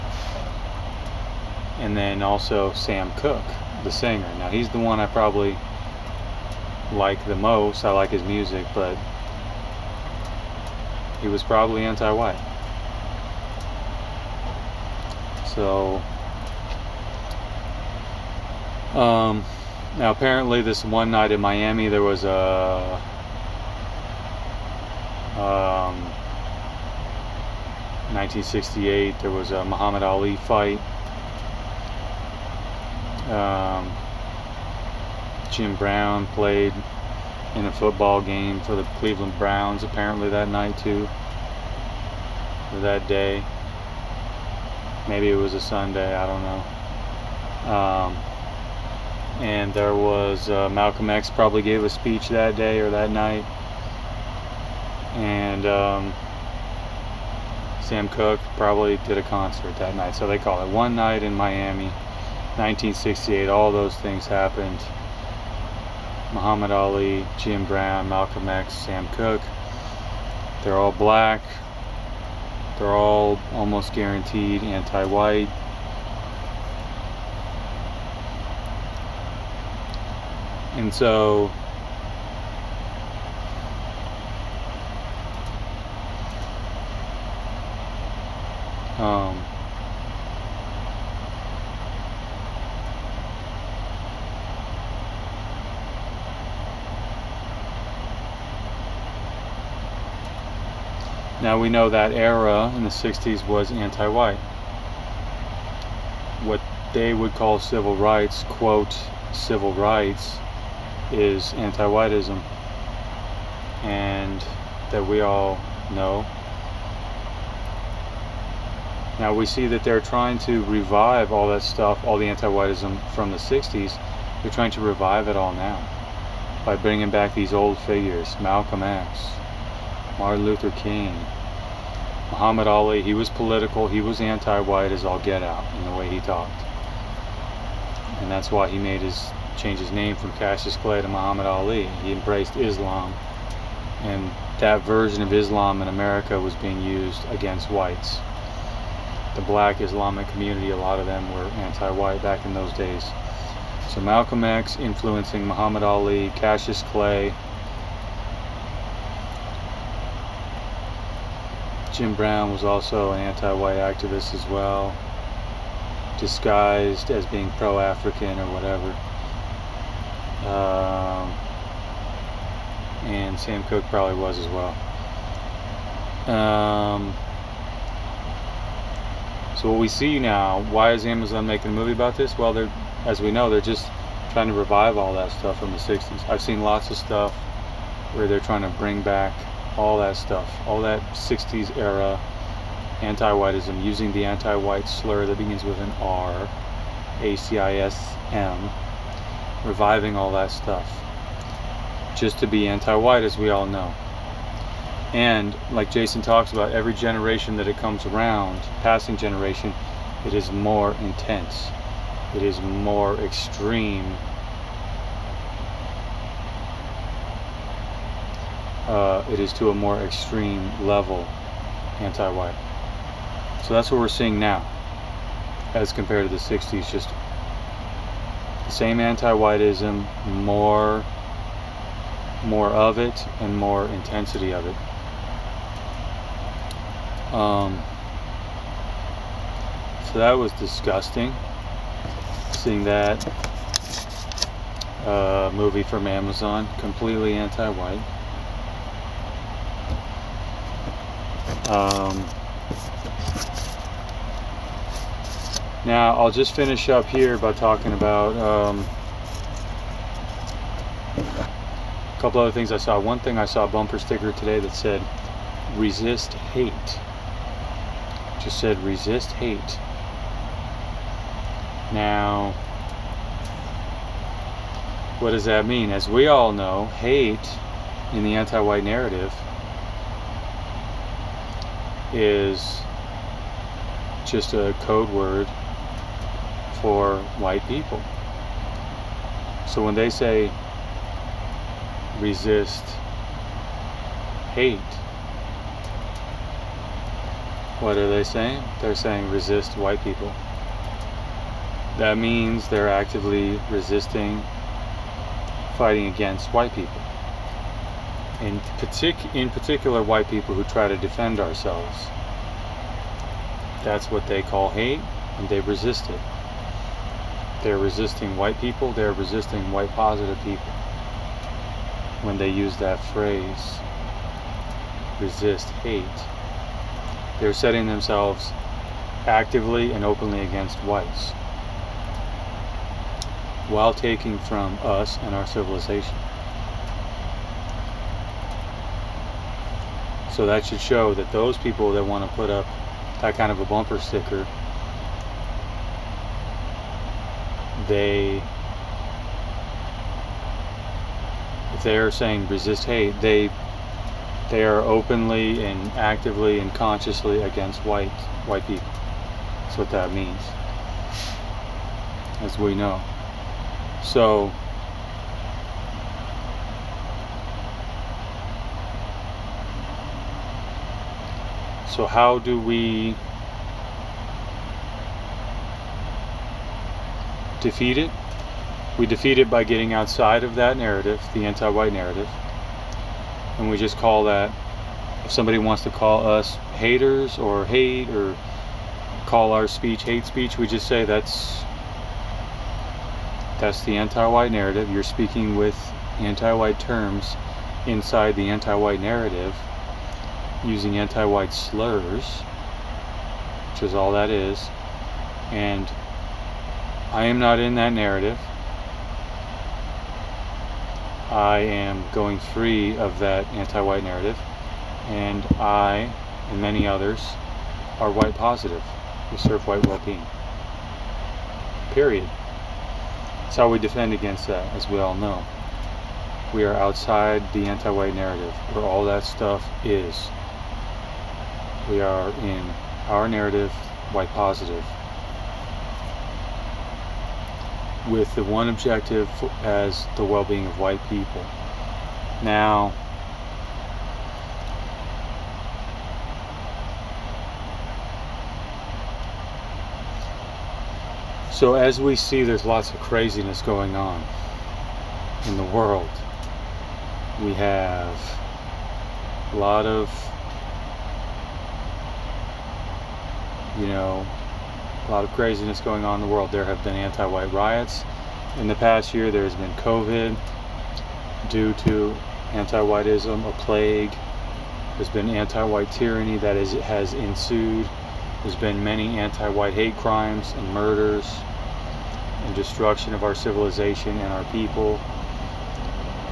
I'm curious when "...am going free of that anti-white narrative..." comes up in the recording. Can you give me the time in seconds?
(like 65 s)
411 s.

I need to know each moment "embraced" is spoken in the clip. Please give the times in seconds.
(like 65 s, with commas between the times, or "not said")
142 s.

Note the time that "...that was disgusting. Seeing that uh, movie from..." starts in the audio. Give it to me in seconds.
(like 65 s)
240 s.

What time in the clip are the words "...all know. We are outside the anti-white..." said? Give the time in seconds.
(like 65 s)
424 s.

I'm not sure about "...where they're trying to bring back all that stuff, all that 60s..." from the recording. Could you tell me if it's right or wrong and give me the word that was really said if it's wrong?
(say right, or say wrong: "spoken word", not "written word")
right.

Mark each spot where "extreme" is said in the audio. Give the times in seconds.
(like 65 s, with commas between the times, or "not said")
213 s, 219 s.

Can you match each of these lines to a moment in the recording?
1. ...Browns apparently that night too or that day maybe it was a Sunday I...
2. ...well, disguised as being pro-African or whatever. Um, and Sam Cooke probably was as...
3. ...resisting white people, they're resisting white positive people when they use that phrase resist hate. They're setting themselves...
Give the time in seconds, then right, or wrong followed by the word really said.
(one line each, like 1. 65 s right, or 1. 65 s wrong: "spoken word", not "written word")
1. 39 s right
2. 164 s right
3. 317 s right.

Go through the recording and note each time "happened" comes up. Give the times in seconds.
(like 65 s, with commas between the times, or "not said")
64 s.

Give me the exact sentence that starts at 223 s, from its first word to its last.
So that's what we're seeing now as compared to the 60s.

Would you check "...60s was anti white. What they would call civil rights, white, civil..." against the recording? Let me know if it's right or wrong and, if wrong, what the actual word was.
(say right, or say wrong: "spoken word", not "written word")
wrong: "quote", not "white".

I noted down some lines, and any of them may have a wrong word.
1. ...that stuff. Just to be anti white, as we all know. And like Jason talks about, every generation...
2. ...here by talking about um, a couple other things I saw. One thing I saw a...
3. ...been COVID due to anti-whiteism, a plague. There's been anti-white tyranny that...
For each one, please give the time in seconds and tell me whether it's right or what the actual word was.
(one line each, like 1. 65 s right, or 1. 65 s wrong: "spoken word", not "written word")
1. 200 s right
2. 257 s right
3. 469 s right.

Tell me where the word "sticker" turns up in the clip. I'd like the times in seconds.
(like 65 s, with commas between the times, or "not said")
263 s, 343 s.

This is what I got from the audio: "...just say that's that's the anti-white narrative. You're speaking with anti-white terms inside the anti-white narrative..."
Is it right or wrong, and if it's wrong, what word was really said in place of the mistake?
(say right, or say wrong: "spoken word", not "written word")
right.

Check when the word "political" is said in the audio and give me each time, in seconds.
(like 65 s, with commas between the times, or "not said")
133 s.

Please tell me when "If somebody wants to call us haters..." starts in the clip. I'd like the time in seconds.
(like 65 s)
385 s.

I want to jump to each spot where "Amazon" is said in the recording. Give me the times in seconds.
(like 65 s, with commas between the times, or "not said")
181 s, 246 s.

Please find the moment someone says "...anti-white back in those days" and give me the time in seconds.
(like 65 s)
151 s.